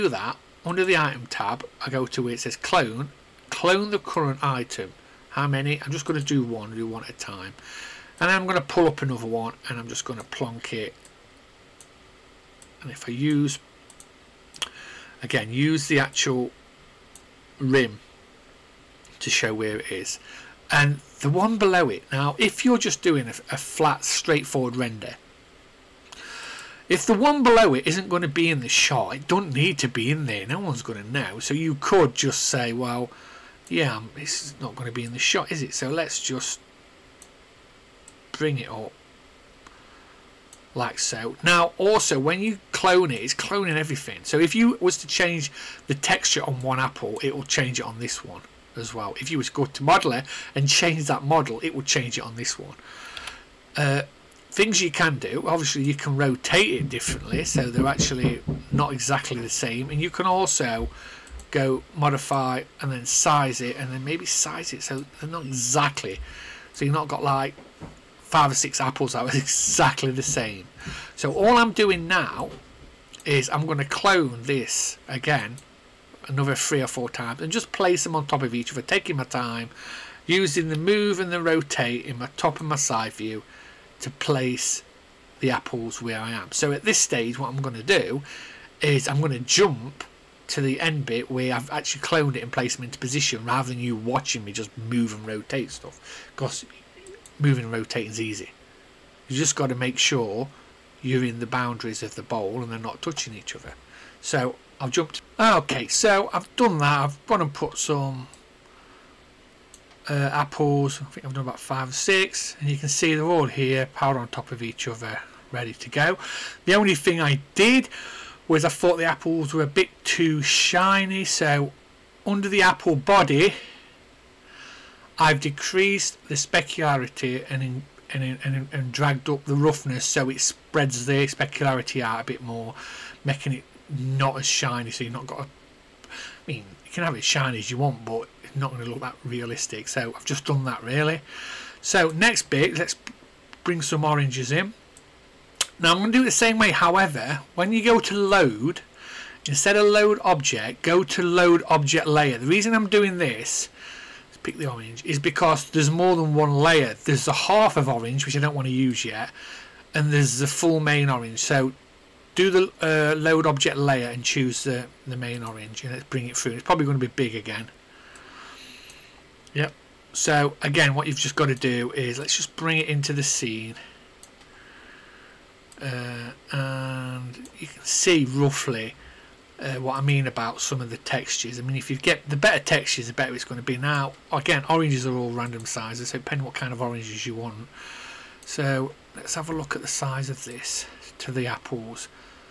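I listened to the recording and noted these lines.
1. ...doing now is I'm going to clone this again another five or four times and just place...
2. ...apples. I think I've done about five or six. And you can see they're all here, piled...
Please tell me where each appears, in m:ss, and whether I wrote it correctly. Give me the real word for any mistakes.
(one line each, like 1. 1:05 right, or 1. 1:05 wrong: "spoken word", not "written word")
1. 1:11 wrong: "three", not "five"
2. 1:50 right.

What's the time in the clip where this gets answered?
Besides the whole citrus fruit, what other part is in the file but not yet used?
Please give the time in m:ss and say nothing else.
2:37.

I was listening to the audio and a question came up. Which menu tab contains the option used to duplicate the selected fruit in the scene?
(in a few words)
item tab.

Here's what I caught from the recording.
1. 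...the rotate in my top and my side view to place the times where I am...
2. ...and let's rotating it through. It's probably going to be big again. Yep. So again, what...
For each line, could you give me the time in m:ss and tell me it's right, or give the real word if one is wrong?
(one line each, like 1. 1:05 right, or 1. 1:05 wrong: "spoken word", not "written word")
1. 1:21 wrong: "apples", not "times"
2. 2:45 wrong: "bring", not "rotating".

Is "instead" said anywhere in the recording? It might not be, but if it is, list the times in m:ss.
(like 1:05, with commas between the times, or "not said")
2:29.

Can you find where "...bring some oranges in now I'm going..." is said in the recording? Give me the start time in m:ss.
2:23.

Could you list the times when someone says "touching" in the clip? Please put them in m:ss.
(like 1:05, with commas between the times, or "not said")
1:43.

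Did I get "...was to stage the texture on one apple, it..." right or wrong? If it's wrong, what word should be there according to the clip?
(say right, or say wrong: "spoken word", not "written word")
wrong: "change", not "stage".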